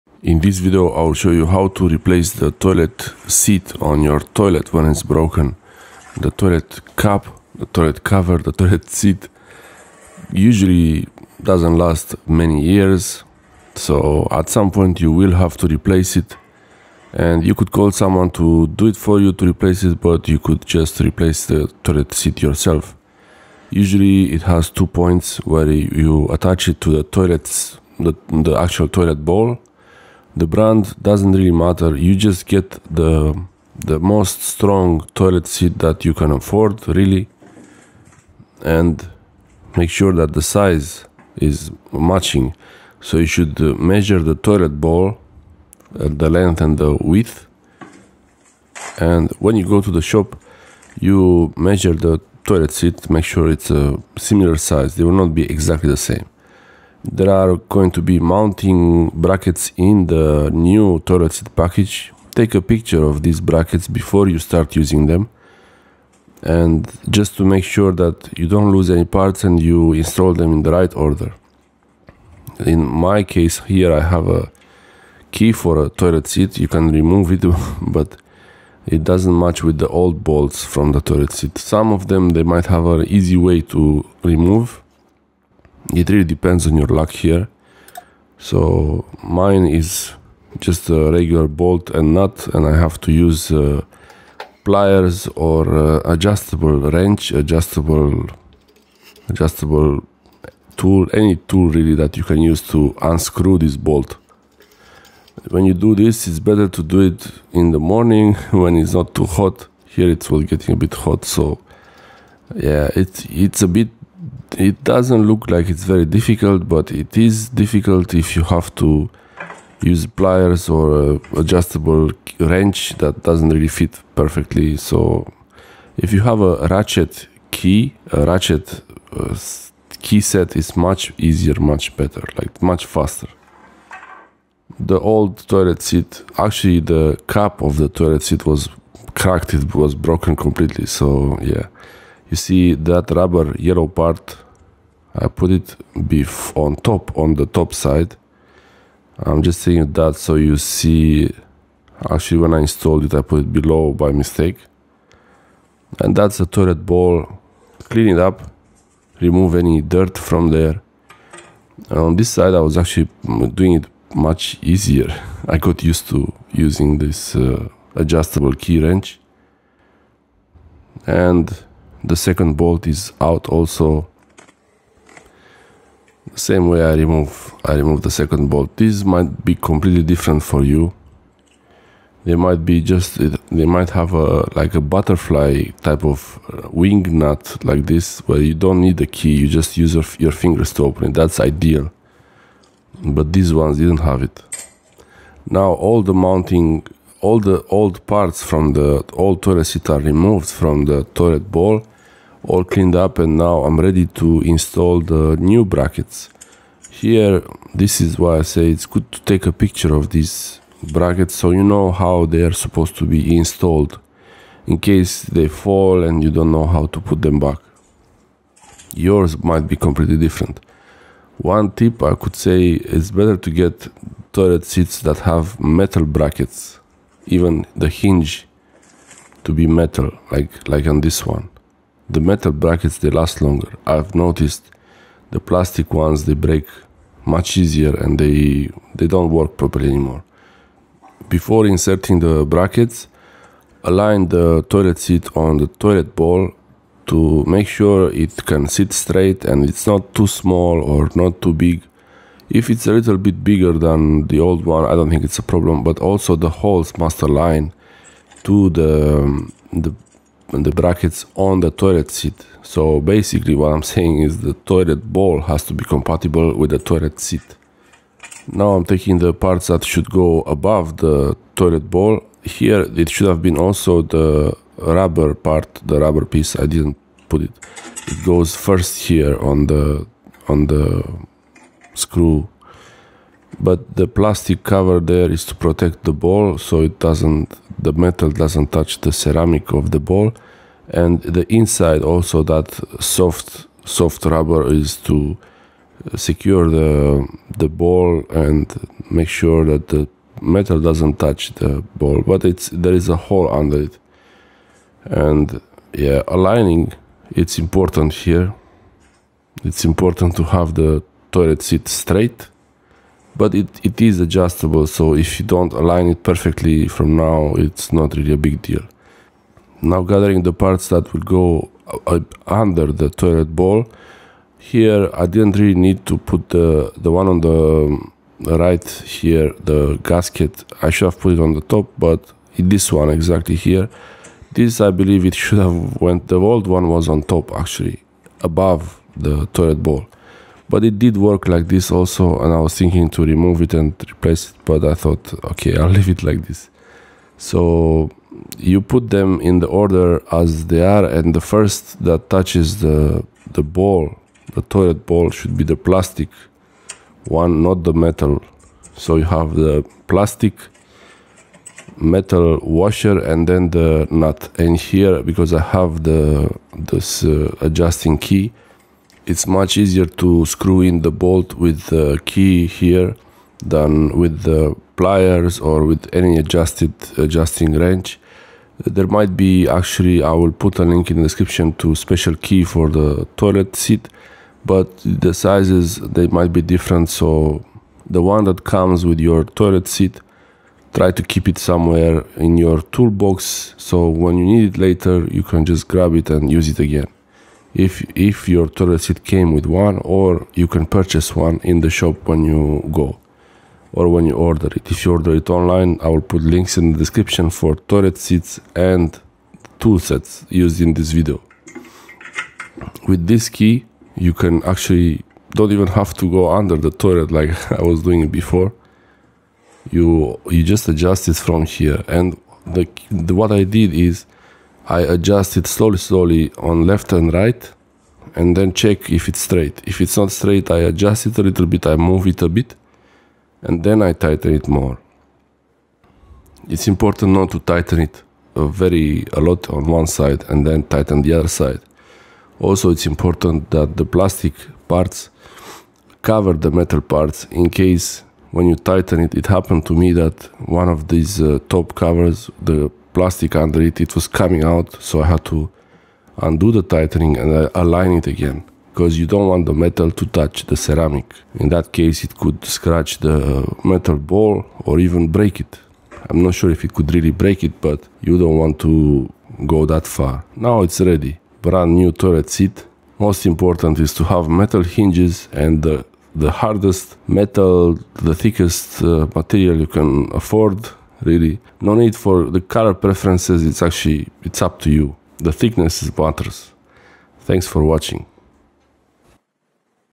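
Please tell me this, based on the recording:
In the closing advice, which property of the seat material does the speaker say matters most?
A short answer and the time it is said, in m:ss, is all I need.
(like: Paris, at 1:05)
Thickness, at 8:05.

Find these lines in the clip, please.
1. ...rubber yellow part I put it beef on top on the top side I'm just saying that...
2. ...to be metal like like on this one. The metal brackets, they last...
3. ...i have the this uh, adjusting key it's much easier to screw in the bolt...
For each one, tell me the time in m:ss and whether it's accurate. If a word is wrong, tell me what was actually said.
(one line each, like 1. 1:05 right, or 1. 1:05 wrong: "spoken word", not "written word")
1. 2:23 right
2. 3:49 right
3. 6:05 right.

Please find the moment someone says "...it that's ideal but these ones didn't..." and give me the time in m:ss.
3:11.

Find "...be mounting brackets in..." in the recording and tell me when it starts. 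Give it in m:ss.
0:58.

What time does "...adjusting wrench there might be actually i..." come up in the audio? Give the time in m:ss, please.
6:17.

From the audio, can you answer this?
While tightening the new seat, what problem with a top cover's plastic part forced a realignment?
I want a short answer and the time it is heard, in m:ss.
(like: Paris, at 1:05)
It was coming out, at 7:33.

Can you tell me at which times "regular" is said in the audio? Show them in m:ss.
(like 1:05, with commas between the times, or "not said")
1:31.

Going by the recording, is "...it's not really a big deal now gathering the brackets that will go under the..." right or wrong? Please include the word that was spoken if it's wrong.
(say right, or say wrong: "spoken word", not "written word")
wrong: "parts", not "brackets".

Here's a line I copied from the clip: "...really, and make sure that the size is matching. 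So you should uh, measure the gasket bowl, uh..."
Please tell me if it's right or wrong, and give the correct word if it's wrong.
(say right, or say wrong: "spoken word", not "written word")
wrong: "toilet", not "gasket".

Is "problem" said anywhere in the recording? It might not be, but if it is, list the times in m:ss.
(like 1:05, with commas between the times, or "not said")
4:15.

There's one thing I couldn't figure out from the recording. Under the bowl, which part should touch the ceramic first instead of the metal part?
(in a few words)
The plastic one.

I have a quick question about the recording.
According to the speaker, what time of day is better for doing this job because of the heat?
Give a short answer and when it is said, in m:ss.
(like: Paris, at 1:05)
In the morning, at 1:47.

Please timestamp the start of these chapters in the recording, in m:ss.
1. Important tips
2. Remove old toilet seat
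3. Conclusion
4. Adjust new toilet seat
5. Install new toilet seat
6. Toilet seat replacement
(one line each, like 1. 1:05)
1. 7:00
2. 1:06
3. 7:50
4. 6:07
5. 3:16
6. 0:16.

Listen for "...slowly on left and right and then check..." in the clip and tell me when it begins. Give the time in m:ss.
7:05.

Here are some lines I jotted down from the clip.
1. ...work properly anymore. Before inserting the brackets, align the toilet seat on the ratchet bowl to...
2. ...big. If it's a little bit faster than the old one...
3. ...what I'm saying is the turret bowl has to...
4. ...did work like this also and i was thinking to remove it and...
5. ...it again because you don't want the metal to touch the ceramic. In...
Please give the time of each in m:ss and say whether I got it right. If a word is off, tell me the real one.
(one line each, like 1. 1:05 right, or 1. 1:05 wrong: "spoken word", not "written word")
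1. 3:59 wrong: "toilet", not "ratchet"
2. 4:11 wrong: "bigger", not "faster"
3. 4:23 wrong: "toilet", not "turret"
4. 5:40 right
5. 7:38 right.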